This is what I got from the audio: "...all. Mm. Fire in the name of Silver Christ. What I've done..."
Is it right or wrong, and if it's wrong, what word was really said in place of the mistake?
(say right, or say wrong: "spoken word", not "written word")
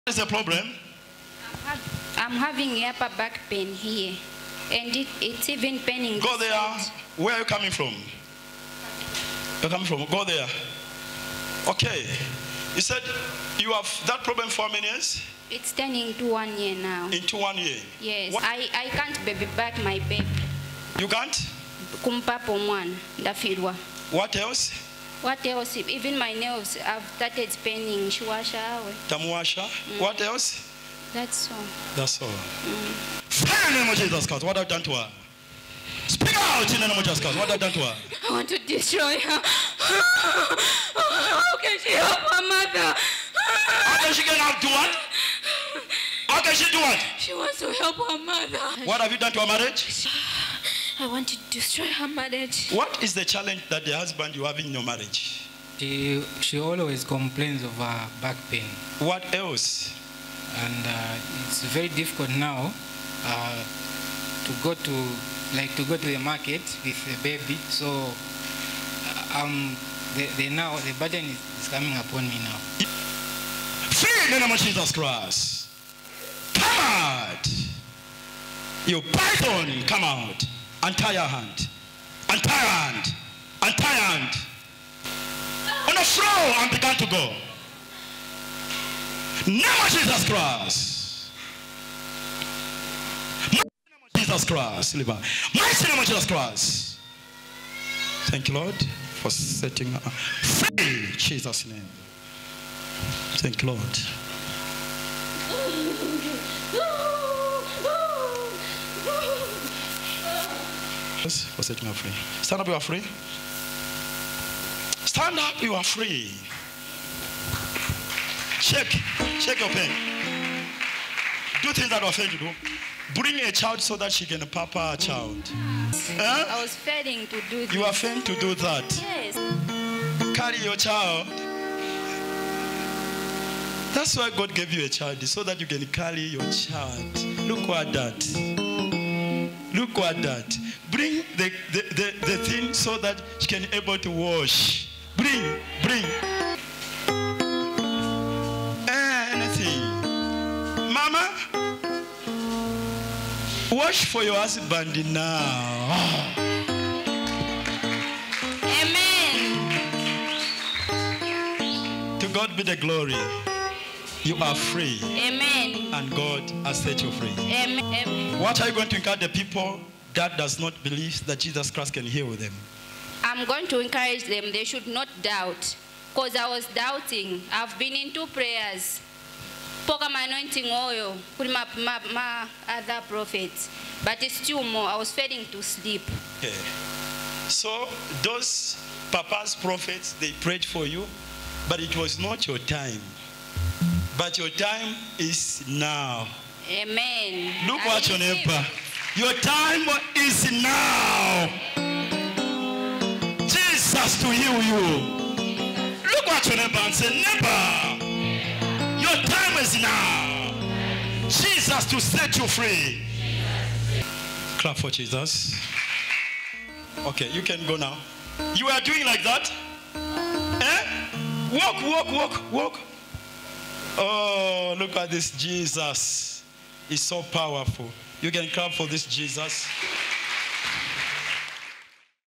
wrong: "Jesus", not "Silver".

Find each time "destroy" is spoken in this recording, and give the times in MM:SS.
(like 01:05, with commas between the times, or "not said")
00:38, 00:51.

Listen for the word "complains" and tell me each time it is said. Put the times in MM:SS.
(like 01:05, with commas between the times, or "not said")
00:57.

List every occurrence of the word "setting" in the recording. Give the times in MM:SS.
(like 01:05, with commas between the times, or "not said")
01:39, 01:51.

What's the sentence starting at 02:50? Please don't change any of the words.
that does not believe that Jesus Christ can heal them.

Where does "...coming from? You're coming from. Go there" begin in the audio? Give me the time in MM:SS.
00:07.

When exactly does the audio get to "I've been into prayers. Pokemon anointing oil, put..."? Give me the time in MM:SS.
02:57.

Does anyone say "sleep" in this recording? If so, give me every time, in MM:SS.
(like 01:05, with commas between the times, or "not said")
03:05.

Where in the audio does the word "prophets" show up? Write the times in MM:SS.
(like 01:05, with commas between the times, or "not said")
03:03, 03:09.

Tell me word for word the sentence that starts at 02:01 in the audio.
Do things that are offend you.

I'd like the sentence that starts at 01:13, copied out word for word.
Free in the name of Jesus Christ.